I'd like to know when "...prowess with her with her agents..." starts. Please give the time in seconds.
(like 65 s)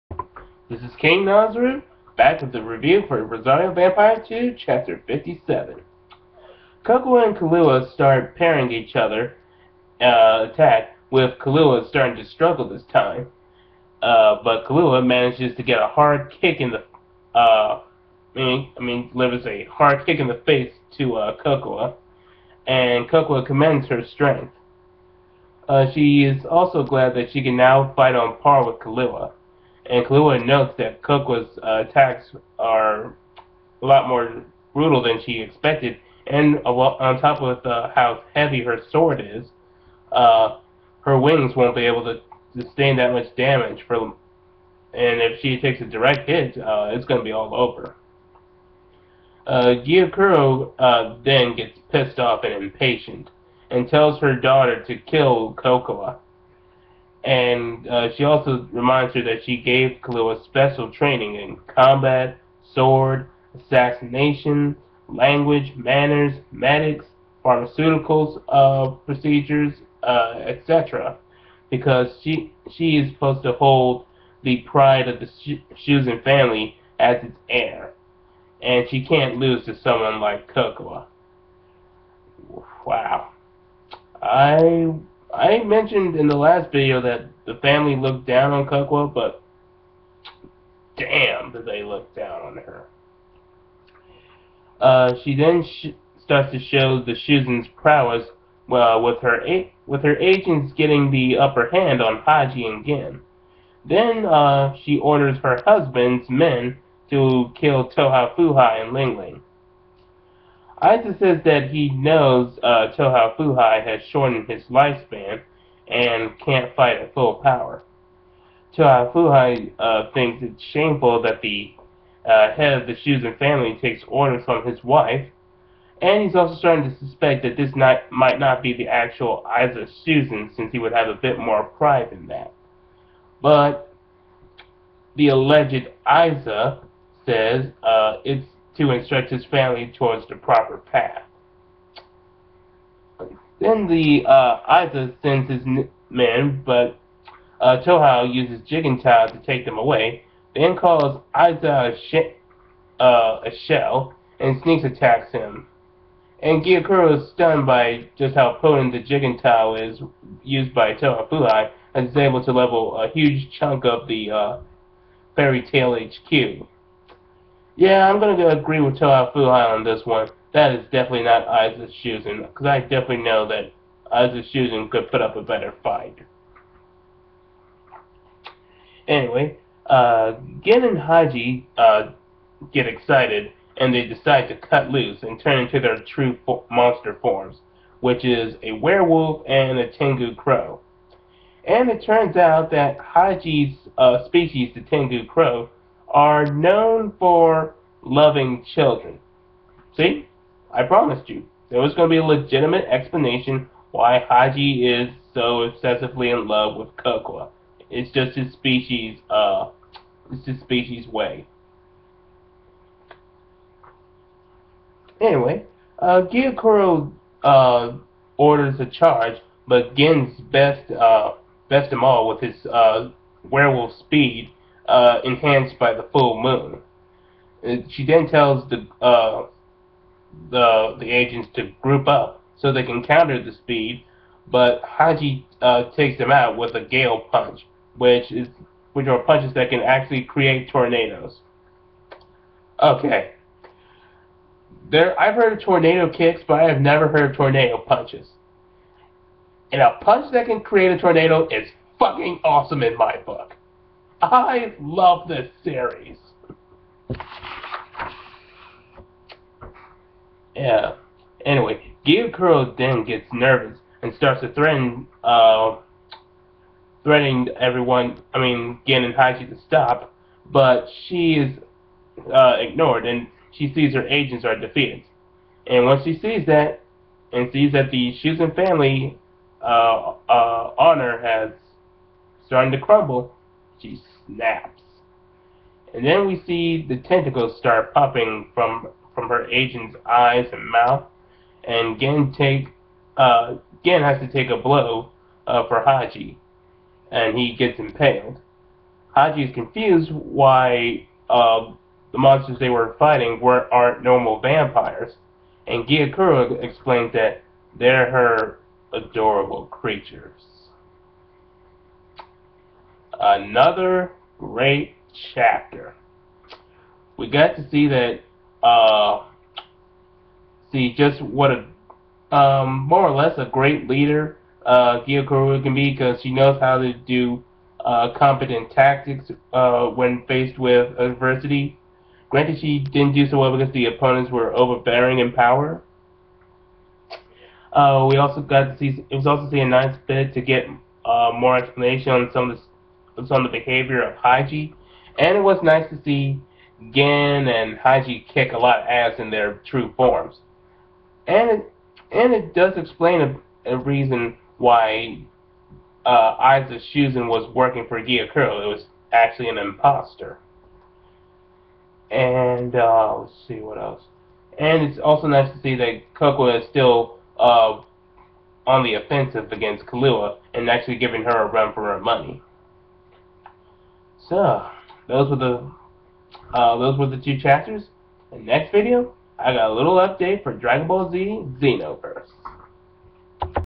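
97 s.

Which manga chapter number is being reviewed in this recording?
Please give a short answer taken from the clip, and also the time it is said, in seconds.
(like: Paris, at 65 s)
57, at 4 s.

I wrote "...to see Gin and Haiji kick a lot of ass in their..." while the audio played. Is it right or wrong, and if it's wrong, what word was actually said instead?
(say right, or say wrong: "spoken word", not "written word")
right.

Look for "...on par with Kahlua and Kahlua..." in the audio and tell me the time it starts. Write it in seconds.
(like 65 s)
28 s.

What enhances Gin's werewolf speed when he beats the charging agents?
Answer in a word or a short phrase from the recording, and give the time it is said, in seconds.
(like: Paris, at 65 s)
The full moon, at 225 s.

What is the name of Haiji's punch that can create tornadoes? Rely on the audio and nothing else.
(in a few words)
Gale punch.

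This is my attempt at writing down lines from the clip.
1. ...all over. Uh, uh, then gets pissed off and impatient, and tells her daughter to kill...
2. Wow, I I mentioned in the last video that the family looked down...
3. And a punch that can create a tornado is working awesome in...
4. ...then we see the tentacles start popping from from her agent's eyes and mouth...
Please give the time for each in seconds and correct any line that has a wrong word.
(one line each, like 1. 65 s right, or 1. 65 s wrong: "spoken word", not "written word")
1. 47 s right
2. 82 s right
3. 249 s wrong: "fucking", not "working"
4. 286 s right.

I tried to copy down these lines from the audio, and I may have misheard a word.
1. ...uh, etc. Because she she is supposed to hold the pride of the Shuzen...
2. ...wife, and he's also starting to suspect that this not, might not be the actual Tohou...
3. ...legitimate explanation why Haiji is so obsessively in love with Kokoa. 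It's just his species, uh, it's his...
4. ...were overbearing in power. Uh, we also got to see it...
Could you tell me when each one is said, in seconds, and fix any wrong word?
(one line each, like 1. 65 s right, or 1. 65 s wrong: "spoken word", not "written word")
1. 70 s right
2. 124 s wrong: "Issa", not "Tohou"
3. 202 s right
4. 334 s right.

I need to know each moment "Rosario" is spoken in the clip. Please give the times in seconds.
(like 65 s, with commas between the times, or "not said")
3 s.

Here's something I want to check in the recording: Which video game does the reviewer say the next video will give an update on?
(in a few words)
Dragon Ball Z Xenoverse.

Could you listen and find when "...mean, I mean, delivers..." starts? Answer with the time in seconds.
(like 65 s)
18 s.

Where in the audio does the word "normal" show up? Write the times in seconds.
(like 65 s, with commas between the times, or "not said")
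304 s.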